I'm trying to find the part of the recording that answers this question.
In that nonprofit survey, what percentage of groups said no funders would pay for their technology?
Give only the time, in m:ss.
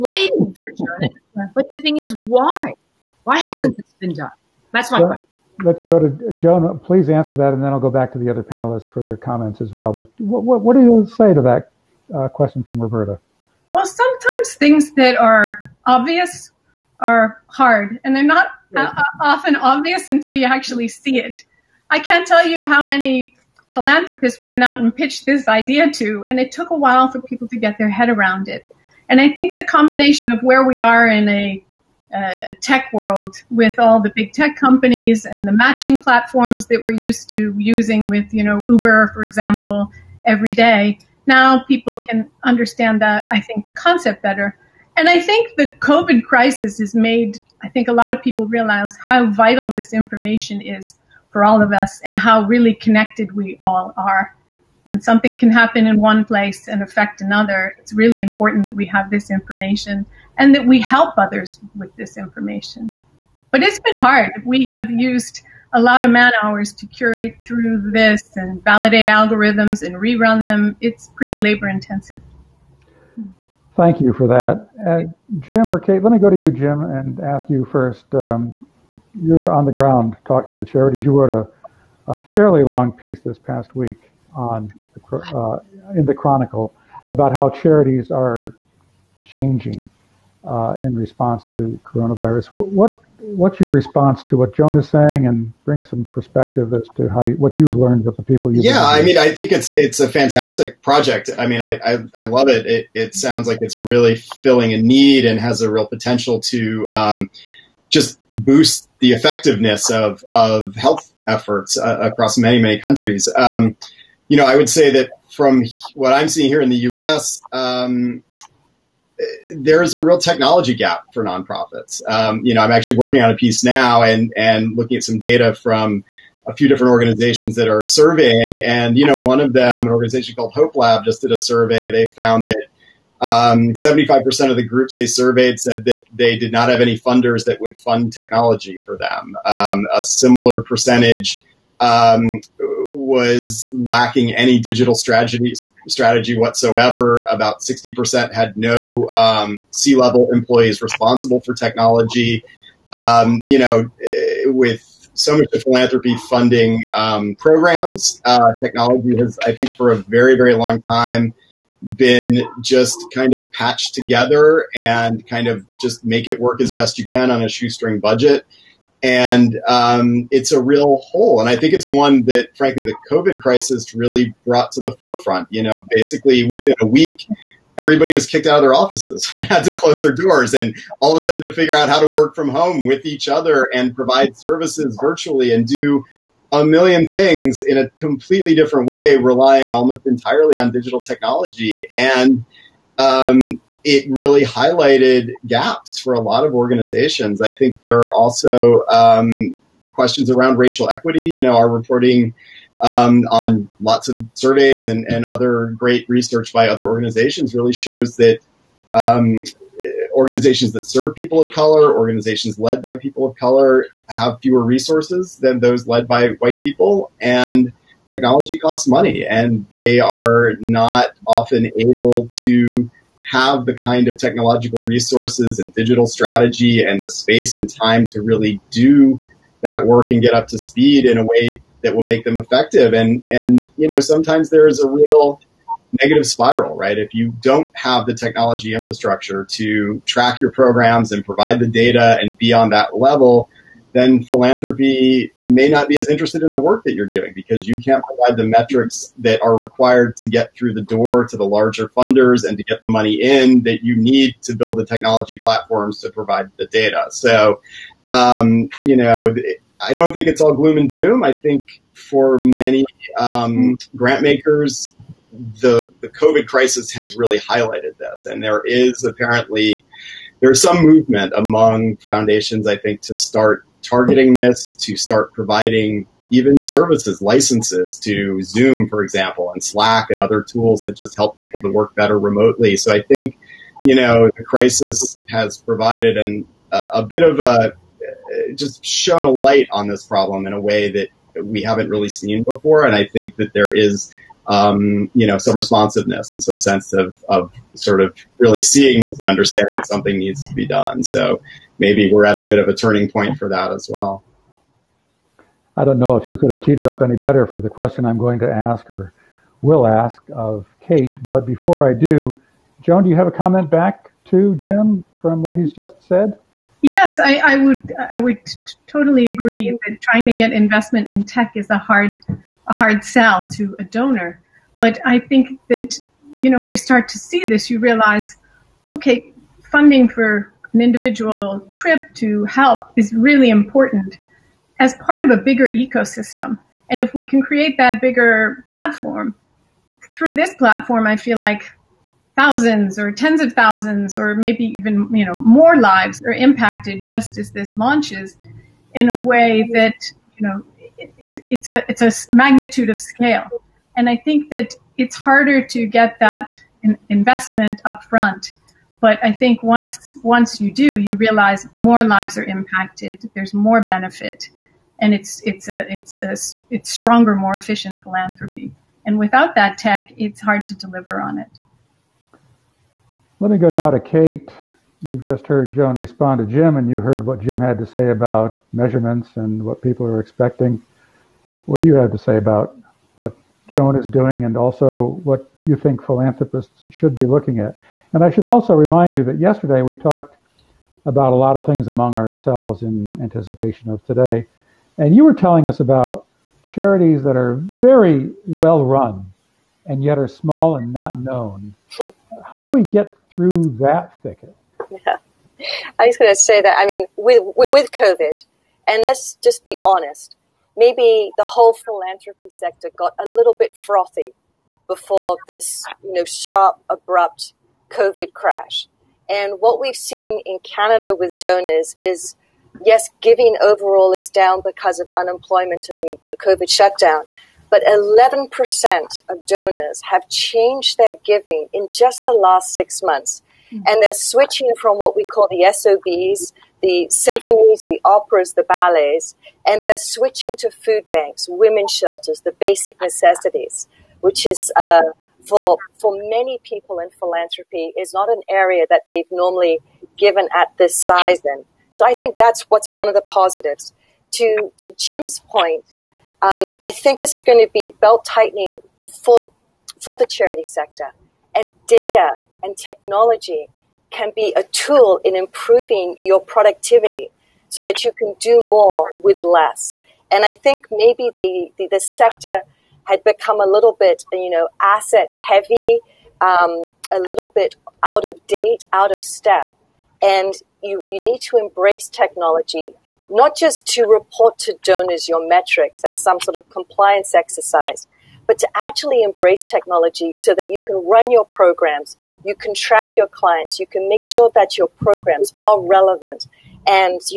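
2:13.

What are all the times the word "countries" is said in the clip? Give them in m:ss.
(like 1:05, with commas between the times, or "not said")
1:52.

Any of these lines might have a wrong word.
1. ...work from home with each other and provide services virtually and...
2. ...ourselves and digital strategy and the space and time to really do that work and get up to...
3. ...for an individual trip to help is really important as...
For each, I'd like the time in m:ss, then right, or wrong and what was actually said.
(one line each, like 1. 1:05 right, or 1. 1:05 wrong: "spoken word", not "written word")
1. 3:02 right
2. 3:44 wrong: "resources", not "ourselves"
3. 5:30 right.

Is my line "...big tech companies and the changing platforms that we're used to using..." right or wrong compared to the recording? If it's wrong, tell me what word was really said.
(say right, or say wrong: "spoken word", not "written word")
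wrong: "matching", not "changing".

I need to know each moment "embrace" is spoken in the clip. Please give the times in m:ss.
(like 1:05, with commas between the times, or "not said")
8:01, 8:09.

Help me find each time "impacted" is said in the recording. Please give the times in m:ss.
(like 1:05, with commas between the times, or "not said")
5:46, 6:02.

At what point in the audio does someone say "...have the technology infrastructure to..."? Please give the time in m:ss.
3:57.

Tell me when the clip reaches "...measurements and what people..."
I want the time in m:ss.
6:18.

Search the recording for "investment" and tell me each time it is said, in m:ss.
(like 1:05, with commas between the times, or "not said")
5:20, 5:57.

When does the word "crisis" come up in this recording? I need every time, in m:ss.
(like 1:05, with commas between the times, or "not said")
0:46, 2:53, 4:26, 4:44.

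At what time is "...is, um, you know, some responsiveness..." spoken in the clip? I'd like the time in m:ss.
4:53.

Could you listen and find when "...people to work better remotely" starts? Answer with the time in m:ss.
4:41.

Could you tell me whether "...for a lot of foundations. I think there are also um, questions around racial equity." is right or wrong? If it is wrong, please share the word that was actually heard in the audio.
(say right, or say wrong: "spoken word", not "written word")
wrong: "organizations", not "foundations".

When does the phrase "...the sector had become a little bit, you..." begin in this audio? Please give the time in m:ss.
7:51.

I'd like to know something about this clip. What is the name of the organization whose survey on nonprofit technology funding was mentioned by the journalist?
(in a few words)
Hope Lab.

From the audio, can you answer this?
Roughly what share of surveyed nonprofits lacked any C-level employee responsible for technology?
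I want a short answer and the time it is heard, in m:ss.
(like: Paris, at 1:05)
60%, at 2:27.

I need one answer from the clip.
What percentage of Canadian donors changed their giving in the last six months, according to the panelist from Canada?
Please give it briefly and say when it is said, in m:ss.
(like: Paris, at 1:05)
11%, at 7:07.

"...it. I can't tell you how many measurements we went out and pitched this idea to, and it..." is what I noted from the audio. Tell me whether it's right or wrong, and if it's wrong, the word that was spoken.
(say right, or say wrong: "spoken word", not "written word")
wrong: "philanthropists", not "measurements".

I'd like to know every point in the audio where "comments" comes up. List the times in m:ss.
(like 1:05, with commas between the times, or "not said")
0:09, 5:13.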